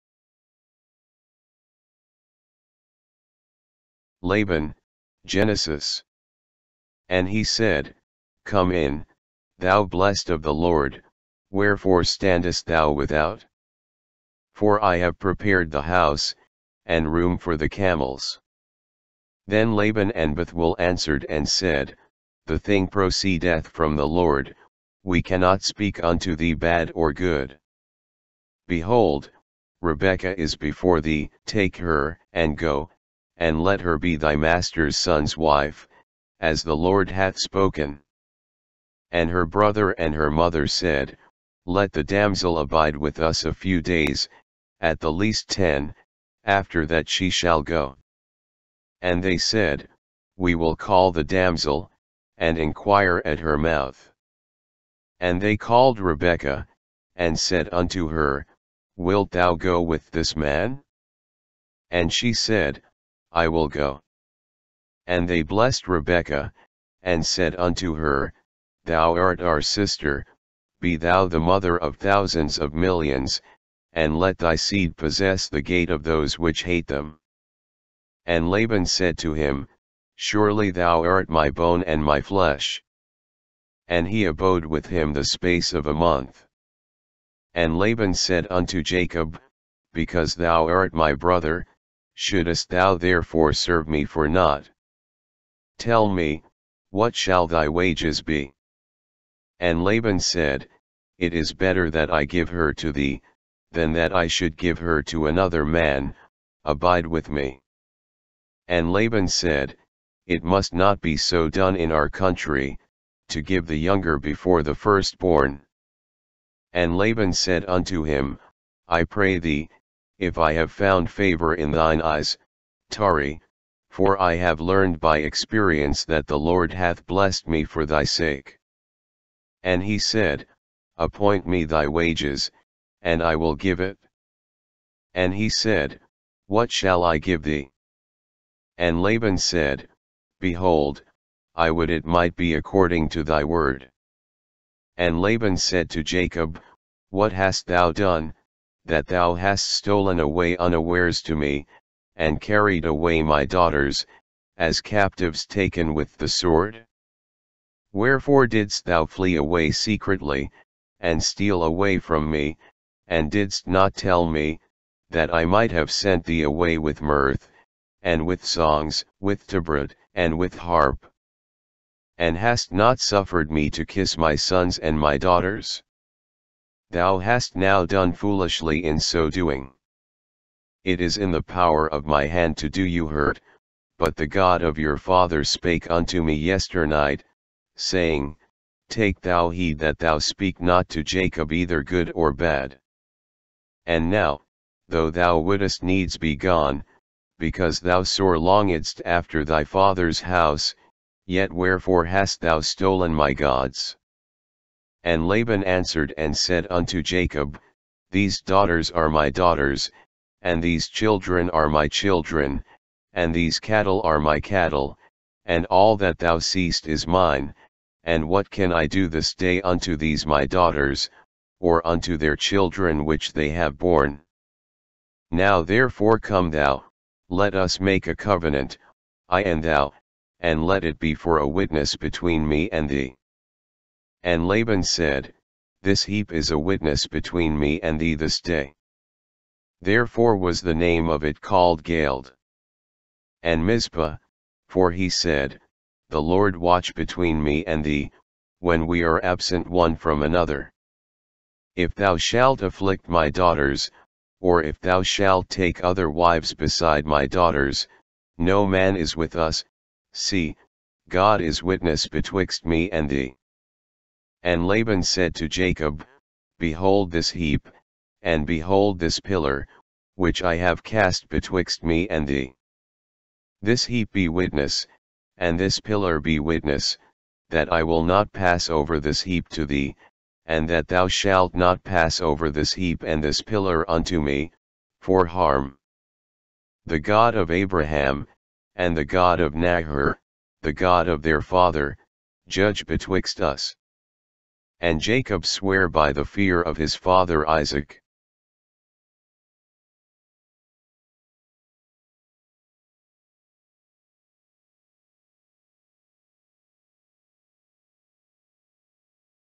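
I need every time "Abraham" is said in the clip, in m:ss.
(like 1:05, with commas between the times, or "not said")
4:47.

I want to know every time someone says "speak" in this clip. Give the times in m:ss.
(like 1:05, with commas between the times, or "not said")
0:25, 3:10.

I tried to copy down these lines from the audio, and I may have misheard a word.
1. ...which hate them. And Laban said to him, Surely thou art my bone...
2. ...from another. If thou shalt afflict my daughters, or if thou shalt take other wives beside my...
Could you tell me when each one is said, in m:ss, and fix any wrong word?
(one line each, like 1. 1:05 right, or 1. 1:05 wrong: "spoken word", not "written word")
1. 1:16 right
2. 4:09 right.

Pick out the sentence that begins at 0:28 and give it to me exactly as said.
Behold, Rebekah is before thee, take her, and go, and let her be thy master's son's wife, as the Lord hath spoken.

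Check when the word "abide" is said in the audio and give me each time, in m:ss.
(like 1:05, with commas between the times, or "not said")
0:42, 1:46.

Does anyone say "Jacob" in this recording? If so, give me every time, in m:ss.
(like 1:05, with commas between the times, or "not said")
1:28, 2:26, 3:11, 3:27, 4:25, 4:54.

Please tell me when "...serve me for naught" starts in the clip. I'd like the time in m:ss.
1:33.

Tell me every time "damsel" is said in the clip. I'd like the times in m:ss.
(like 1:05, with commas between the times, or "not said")
0:42, 0:51.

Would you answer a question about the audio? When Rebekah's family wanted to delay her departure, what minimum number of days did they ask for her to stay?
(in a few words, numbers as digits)
10.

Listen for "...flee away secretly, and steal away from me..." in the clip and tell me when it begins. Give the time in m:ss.
2:39.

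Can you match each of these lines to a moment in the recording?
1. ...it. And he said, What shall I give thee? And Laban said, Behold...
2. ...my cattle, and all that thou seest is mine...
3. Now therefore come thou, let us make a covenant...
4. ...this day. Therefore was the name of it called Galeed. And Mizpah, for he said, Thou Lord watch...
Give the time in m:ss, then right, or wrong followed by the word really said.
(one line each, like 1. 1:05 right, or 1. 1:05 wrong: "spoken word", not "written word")
1. 2:13 right
2. 3:34 right
3. 3:45 right
4. 3:58 wrong: "The", not "Thou".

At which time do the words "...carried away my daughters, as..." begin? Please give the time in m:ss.
2:32.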